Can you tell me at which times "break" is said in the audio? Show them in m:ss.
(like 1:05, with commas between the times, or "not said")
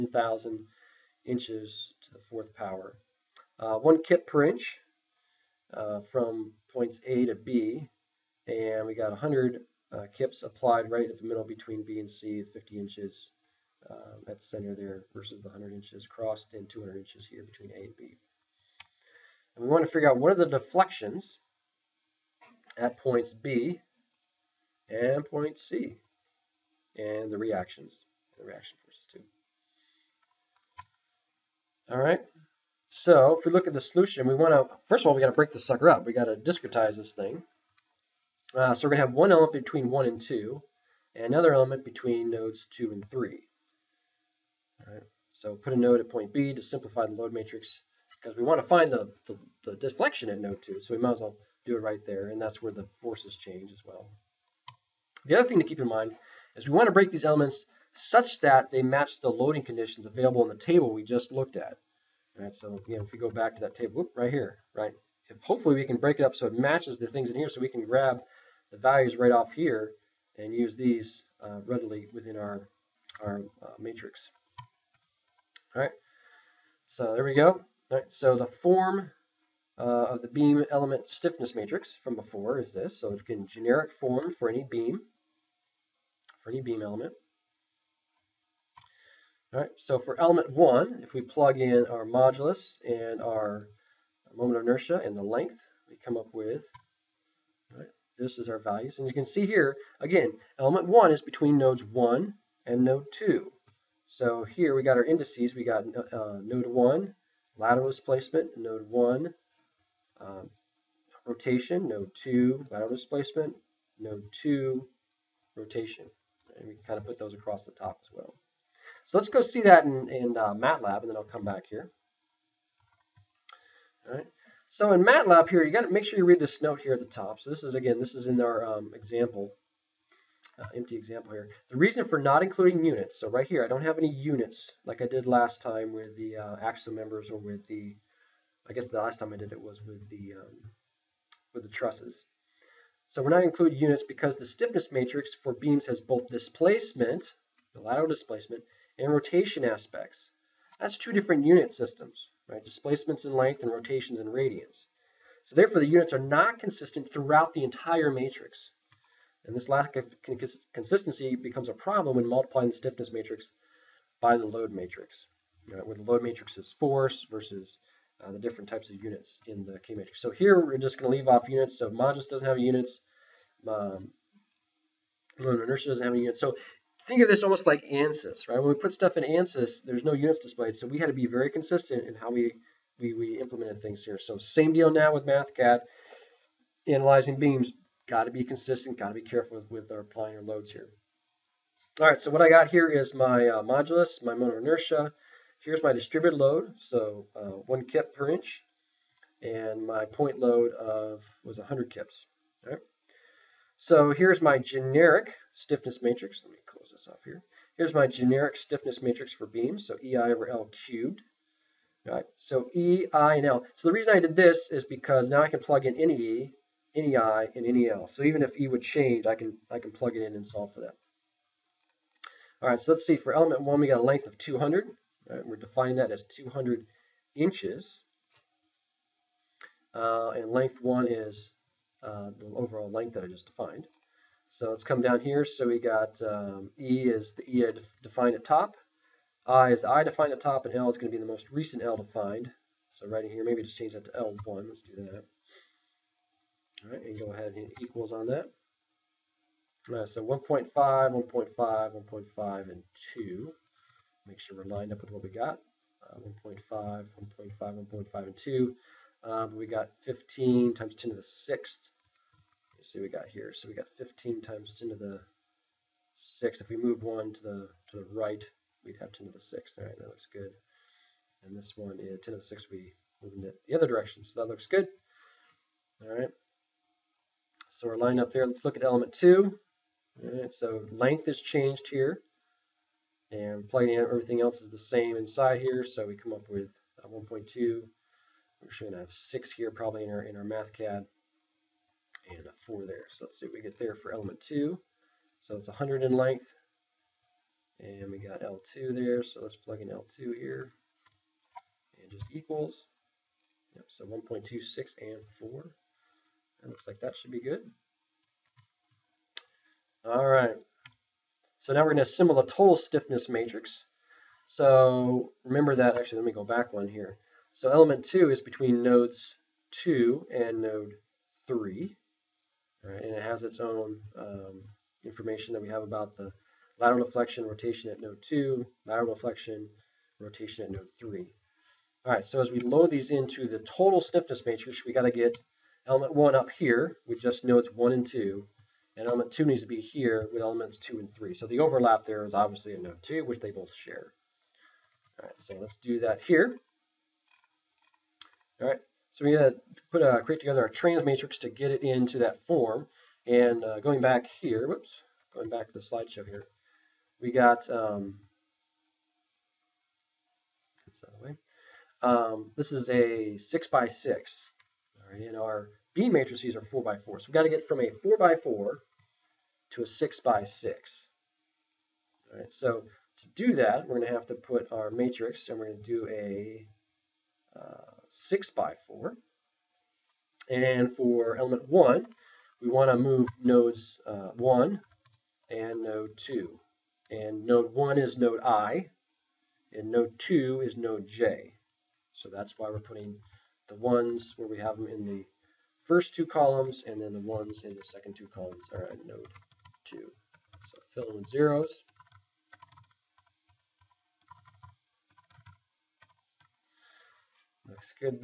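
0:35, 0:56, 1:05.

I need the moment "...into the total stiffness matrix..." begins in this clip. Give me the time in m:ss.
5:33.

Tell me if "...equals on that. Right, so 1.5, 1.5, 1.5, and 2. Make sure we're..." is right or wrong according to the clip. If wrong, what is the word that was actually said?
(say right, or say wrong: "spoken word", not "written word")
right.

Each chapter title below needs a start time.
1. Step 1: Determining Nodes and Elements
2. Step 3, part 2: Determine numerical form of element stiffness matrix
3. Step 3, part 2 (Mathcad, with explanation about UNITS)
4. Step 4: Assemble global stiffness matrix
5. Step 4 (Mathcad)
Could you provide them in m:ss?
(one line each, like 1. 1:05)
1. 0:30
2. 1:28
3. 2:02
4. 5:08
5. 5:44.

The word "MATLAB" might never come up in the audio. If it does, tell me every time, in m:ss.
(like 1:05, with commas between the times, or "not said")
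2:00, 2:05.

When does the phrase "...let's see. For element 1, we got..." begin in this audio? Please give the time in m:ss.
3:42.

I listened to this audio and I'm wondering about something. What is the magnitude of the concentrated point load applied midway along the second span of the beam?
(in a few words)
100 kips.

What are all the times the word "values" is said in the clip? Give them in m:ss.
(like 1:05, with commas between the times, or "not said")
1:08, 1:38.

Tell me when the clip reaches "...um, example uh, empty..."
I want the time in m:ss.
2:08.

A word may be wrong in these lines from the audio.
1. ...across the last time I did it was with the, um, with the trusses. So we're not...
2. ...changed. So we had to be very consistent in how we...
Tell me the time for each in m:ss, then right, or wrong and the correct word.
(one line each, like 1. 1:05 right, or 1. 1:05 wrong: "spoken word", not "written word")
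1. 2:18 wrong: "guess", not "across"
2. 3:00 wrong: "displayed", not "changed".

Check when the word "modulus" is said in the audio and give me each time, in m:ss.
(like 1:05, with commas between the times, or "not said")
1:32, 2:51, 3:13.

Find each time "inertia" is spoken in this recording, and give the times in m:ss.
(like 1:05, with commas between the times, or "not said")
1:34, 2:55, 3:14.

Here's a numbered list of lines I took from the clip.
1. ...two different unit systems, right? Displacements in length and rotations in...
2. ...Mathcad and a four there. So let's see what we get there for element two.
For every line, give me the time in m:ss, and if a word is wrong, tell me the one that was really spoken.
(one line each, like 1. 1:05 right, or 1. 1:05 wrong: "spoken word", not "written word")
1. 2:30 right
2. 4:50 right.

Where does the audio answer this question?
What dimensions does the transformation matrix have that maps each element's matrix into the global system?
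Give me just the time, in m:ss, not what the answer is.
6:18.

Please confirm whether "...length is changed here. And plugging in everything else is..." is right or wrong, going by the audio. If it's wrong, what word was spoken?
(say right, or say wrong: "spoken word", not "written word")
right.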